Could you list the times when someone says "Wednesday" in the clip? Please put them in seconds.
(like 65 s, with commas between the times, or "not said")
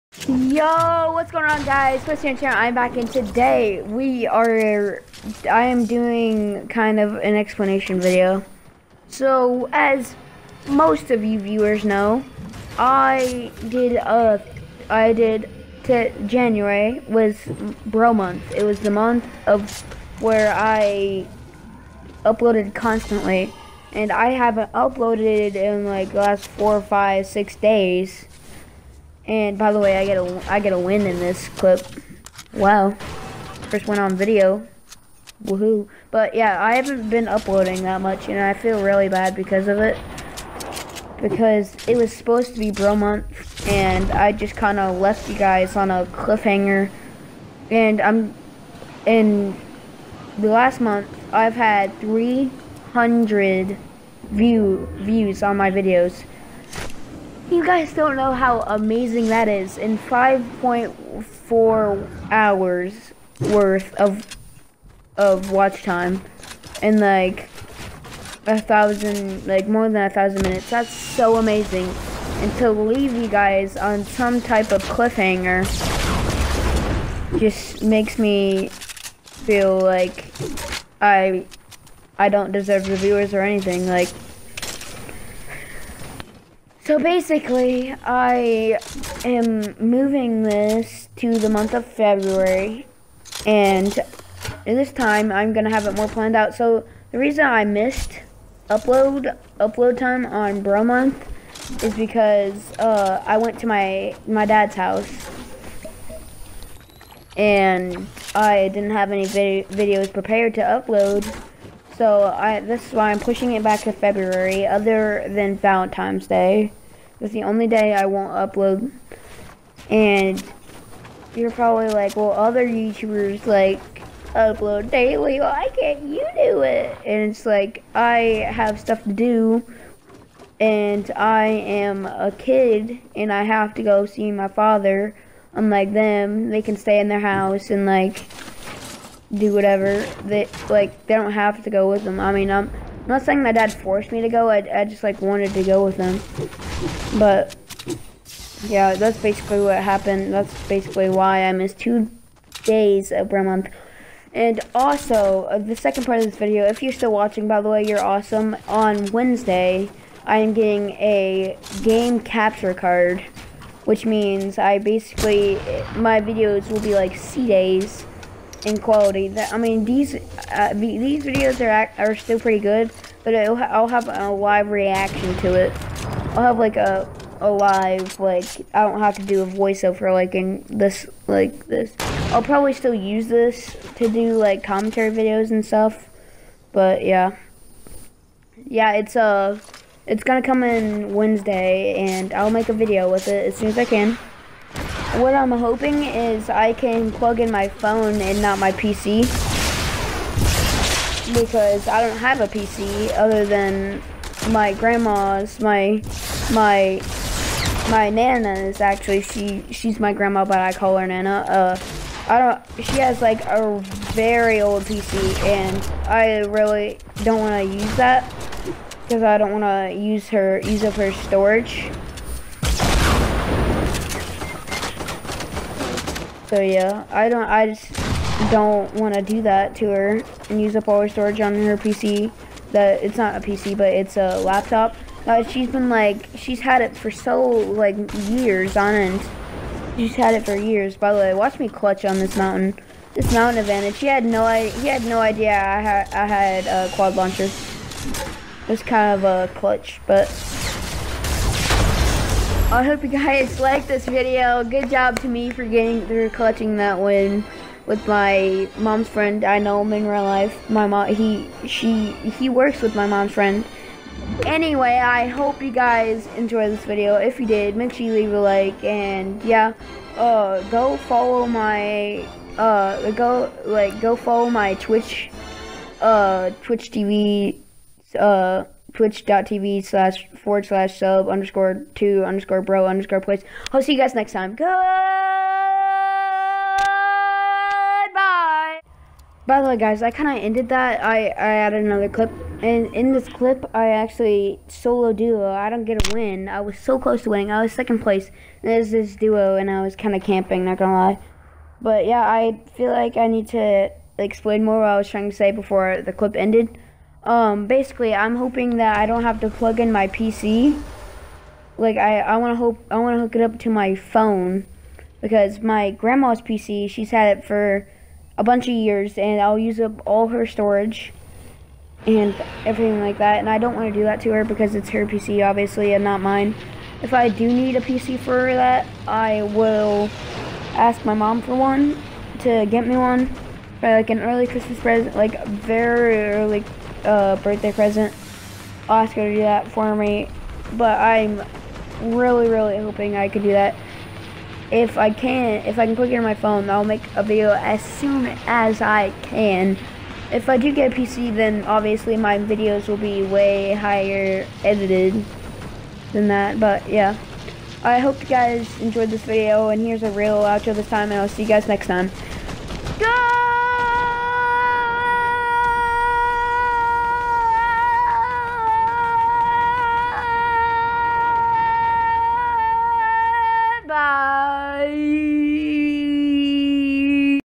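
159 s, 191 s.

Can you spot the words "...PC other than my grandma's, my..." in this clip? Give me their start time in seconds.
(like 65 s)
202 s.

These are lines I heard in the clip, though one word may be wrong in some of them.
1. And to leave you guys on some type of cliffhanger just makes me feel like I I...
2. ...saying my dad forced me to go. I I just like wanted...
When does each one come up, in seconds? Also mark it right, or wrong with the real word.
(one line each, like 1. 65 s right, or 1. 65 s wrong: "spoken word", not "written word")
1. 72 s right
2. 143 s right.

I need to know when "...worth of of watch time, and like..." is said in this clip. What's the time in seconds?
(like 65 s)
63 s.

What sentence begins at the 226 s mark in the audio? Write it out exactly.
So yeah, I don't, I just don't want to do that to her and use up all her storage on her PC.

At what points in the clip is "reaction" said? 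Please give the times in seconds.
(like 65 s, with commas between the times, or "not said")
174 s.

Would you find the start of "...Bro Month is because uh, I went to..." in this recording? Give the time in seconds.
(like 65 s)
100 s.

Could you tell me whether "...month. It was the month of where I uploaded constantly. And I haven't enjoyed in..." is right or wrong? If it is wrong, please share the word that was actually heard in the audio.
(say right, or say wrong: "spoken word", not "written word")
wrong: "uploaded", not "enjoyed".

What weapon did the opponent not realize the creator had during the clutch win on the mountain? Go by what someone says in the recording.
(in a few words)
Quad launcher.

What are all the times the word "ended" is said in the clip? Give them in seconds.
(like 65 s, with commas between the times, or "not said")
290 s, 306 s.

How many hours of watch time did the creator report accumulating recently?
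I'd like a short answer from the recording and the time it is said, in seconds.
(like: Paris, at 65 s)
5.4, at 59 s.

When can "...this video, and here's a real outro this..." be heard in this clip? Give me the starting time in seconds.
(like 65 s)
359 s.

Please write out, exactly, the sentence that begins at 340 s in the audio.
But I'm really, really hoping I could do that.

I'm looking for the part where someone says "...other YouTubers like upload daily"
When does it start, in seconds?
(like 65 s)
122 s.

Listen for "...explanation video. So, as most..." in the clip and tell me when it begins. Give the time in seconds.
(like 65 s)
7 s.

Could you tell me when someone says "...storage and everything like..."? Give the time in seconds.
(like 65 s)
320 s.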